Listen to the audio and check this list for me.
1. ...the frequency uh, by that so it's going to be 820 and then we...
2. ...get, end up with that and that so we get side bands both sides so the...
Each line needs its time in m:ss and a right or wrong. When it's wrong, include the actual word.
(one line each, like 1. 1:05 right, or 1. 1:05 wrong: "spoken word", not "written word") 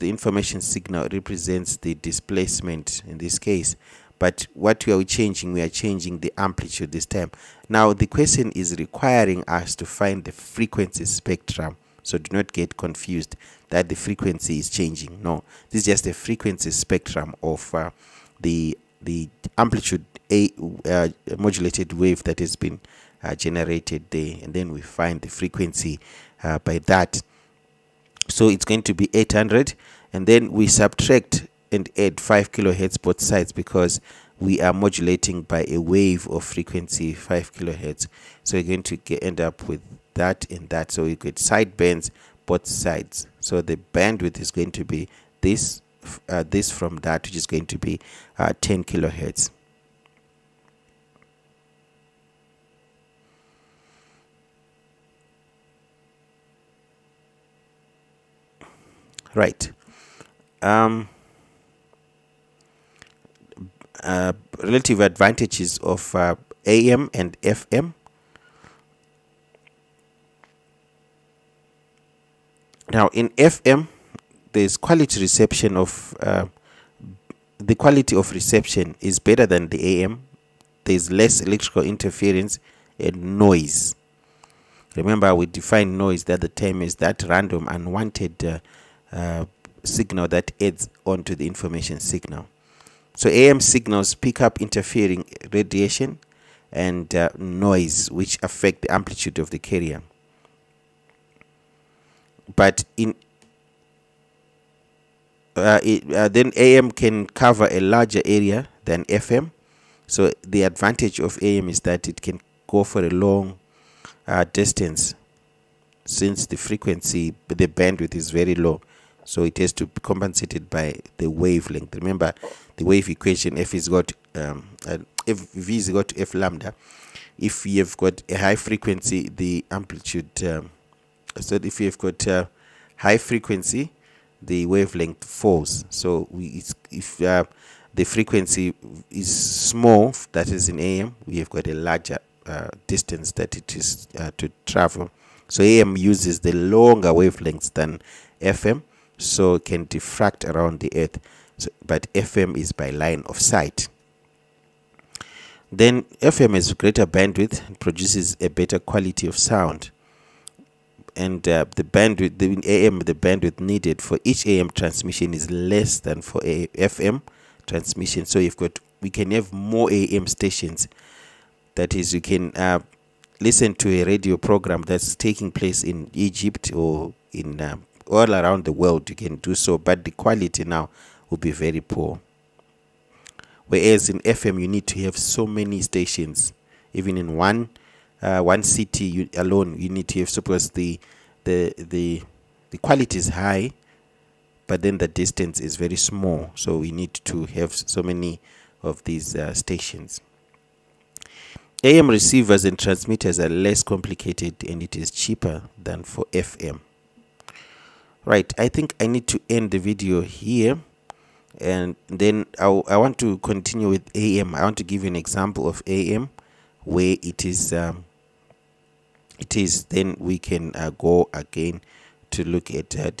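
1. 0:25 wrong: "800", not "820"
2. 0:38 right.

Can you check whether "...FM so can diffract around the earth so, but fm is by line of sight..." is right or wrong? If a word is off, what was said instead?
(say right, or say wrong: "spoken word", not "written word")
right.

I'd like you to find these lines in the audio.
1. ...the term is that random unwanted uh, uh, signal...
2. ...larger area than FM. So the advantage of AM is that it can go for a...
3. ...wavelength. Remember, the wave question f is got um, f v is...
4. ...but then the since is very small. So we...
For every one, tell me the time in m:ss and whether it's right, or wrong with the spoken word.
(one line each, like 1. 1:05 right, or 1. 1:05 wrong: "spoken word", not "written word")
1. 1:26 right
2. 1:47 right
3. 2:01 wrong: "equation", not "question"
4. 3:14 wrong: "distance", not "since".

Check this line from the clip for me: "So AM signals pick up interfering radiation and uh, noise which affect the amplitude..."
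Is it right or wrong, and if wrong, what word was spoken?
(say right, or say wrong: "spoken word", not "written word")
right.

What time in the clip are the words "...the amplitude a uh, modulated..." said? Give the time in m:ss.
0:19.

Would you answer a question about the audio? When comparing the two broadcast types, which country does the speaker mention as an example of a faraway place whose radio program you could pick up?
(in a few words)
Egypt.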